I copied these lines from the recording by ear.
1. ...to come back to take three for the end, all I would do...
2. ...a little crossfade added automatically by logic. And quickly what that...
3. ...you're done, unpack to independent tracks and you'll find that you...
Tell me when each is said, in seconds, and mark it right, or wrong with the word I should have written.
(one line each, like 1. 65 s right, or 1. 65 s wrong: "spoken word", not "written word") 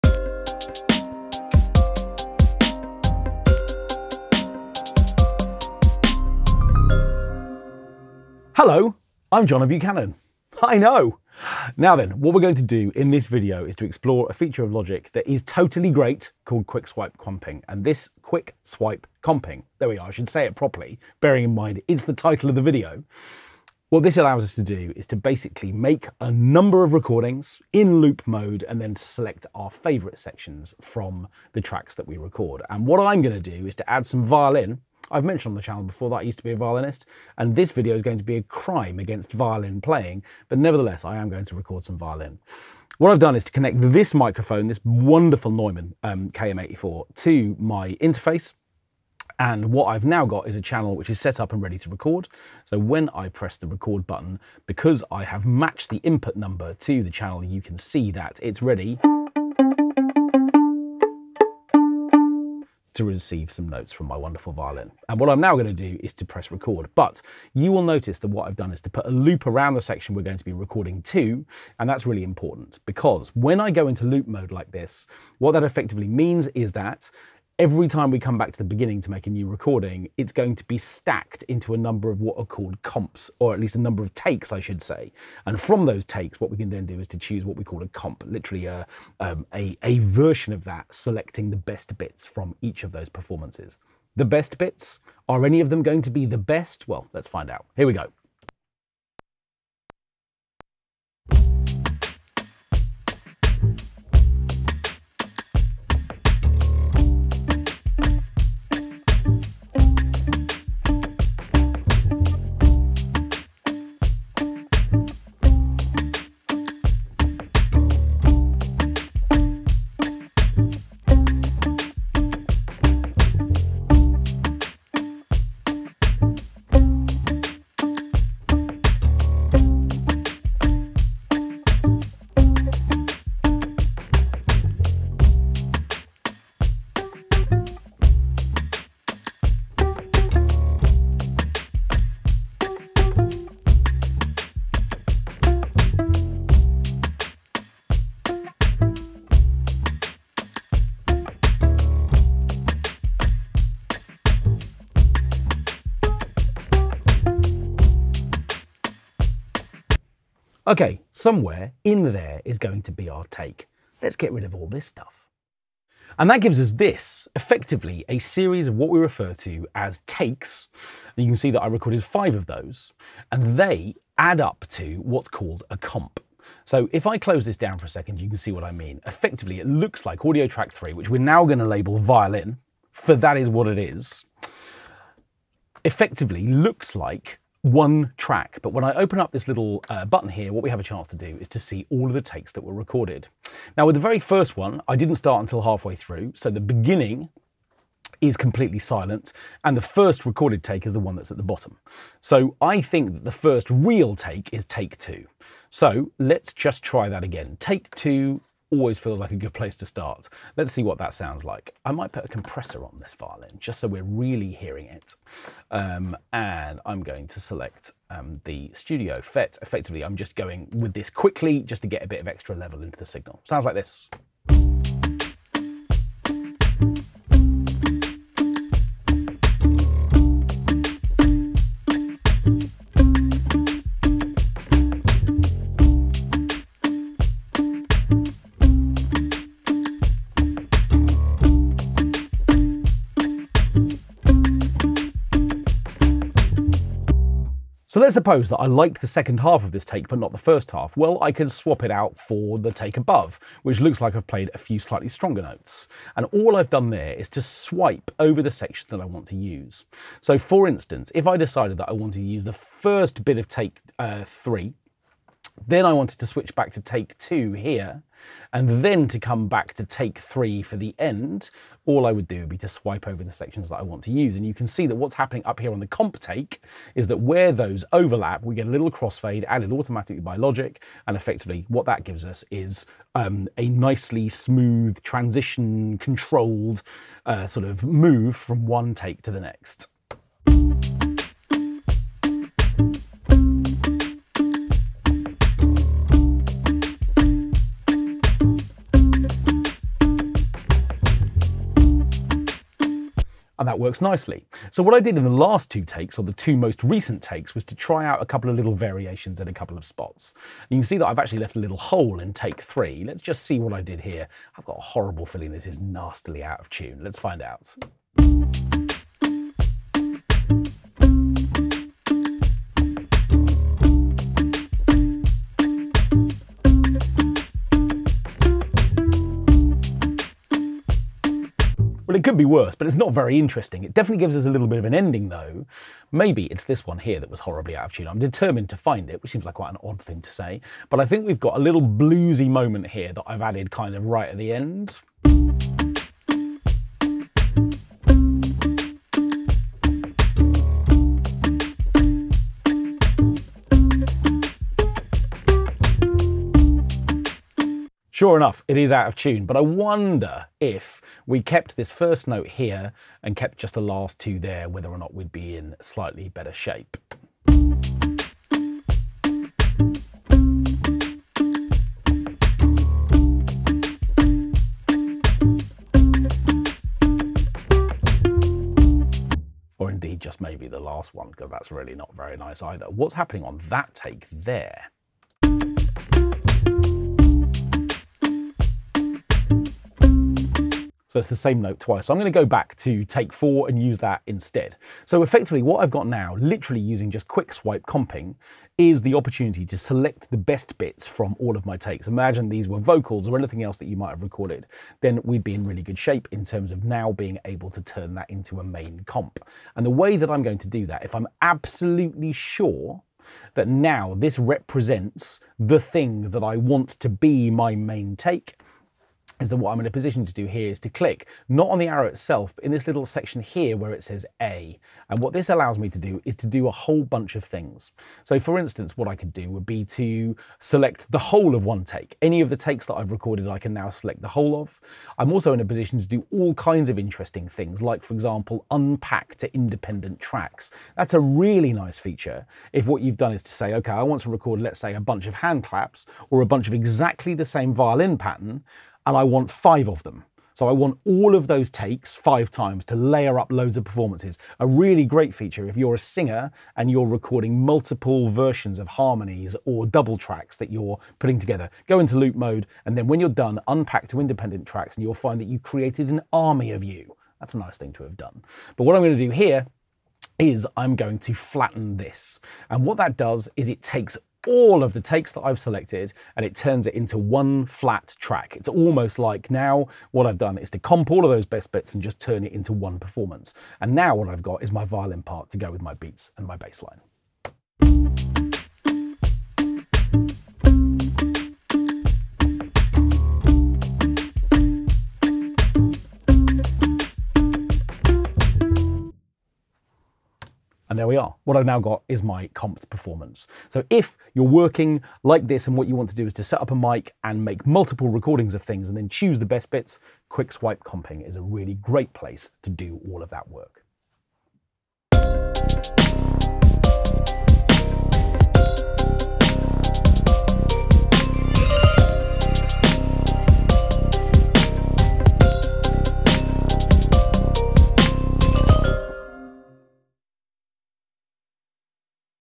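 1. 269 s right
2. 278 s wrong: "effectively", not "quickly"
3. 463 s right.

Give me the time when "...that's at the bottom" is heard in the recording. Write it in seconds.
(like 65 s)
201 s.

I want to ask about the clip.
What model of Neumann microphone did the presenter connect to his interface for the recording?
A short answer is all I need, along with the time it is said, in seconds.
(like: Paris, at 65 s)
KM84, at 46 s.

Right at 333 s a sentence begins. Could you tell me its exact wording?
It definitely gives us a little bit of an ending, though.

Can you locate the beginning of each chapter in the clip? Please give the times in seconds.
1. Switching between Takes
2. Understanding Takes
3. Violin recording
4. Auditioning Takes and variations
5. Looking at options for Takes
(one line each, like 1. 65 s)
1. 247 s
2. 164 s
3. 97 s
4. 305 s
5. 390 s.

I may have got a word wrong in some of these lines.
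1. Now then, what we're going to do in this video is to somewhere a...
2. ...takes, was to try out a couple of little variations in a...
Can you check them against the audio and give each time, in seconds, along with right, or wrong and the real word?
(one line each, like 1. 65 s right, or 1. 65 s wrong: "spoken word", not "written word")
1. 11 s wrong: "explore", not "somewhere"
2. 307 s right.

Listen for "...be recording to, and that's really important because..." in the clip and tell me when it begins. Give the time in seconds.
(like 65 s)
70 s.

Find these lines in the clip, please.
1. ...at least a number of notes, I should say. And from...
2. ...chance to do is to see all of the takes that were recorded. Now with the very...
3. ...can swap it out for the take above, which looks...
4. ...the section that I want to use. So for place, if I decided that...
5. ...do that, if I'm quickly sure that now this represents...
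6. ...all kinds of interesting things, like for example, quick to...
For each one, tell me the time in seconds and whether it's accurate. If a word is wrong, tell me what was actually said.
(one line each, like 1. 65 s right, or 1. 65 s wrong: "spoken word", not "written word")
1. 83 s wrong: "takes", not "notes"
2. 190 s right
3. 251 s right
4. 258 s wrong: "instance", not "place"
5. 410 s wrong: "absolutely", not "quickly"
6. 436 s wrong: "unpack", not "quick".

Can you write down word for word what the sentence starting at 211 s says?
I might put a compressor on this violin just so we're really hearing it.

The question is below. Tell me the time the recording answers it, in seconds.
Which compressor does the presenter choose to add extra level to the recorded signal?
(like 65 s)
218 s.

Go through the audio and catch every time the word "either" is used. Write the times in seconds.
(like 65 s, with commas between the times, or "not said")
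382 s.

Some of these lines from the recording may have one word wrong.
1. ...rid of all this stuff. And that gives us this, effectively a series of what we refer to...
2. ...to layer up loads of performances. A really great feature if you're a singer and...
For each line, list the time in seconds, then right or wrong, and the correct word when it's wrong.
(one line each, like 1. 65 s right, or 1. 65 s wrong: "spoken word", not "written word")
1. 164 s right
2. 452 s right.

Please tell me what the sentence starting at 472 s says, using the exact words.
And what that does is it takes all of the takes that I've selected and it turns it into one flat track.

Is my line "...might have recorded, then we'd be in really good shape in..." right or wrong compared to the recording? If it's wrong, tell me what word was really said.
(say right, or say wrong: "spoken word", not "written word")
right.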